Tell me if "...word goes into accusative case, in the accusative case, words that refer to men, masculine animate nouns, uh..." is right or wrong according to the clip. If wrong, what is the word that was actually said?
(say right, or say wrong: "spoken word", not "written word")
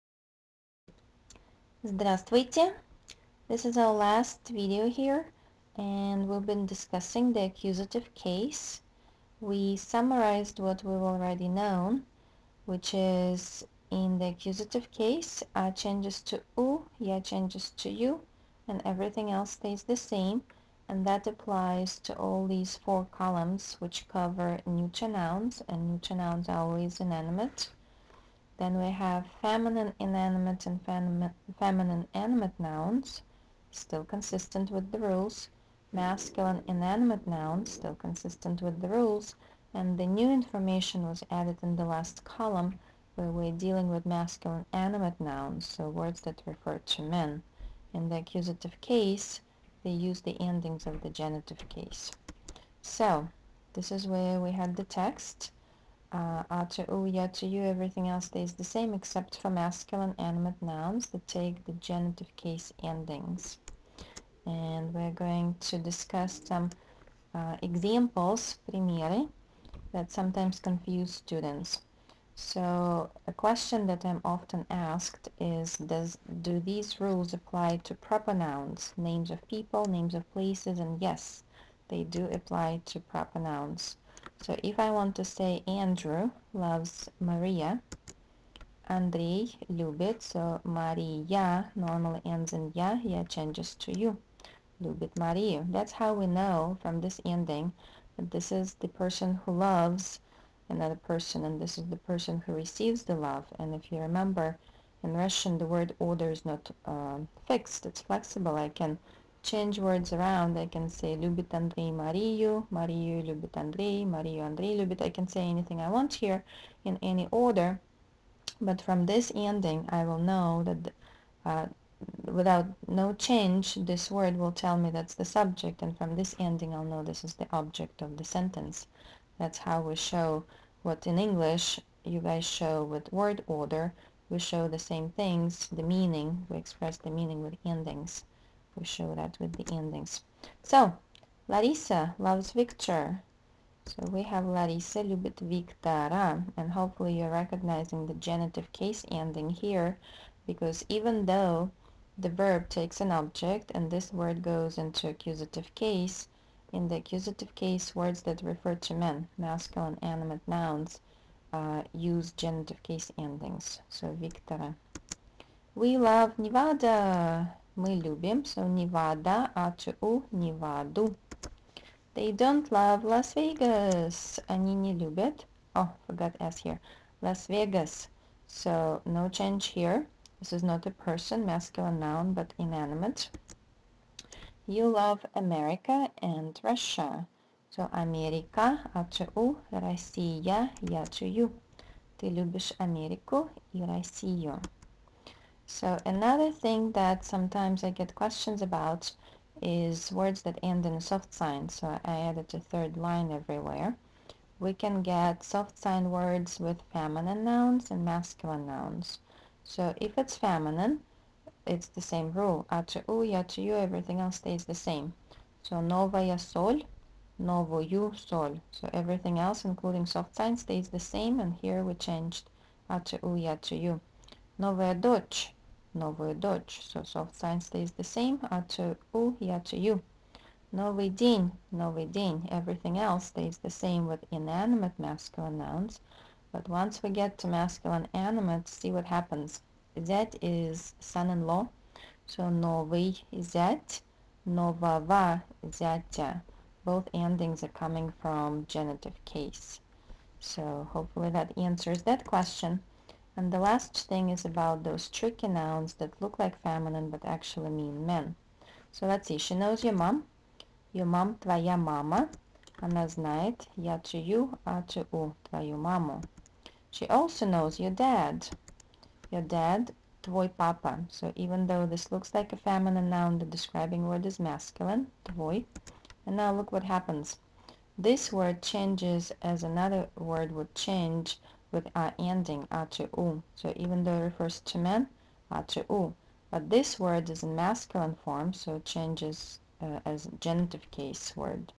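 right.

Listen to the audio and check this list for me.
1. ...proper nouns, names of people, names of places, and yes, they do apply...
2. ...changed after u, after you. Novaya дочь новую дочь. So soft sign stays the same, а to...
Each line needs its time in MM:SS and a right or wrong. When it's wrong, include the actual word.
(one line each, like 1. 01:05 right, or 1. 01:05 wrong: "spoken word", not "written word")
1. 01:17 right
2. 03:41 right.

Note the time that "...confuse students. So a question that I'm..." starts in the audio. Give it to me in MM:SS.
01:10.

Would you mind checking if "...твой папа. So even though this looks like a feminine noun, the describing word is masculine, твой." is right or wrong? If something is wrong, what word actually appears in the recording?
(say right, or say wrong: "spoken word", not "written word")
right.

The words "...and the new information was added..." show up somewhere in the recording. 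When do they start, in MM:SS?
00:39.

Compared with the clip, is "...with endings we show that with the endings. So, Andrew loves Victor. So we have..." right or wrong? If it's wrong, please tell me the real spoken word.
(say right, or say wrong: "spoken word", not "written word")
wrong: "Larissa", not "Andrew".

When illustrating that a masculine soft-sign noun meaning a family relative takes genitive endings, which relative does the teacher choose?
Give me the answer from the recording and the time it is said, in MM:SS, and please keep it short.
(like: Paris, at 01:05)
son-in-law, at 04:01.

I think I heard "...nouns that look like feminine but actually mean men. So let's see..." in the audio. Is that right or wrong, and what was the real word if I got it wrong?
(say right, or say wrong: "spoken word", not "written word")
right.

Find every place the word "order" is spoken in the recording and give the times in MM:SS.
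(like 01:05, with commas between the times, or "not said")
01:45, 01:57, 02:13.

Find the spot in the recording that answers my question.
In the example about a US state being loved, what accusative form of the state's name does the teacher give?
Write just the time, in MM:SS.
02:50.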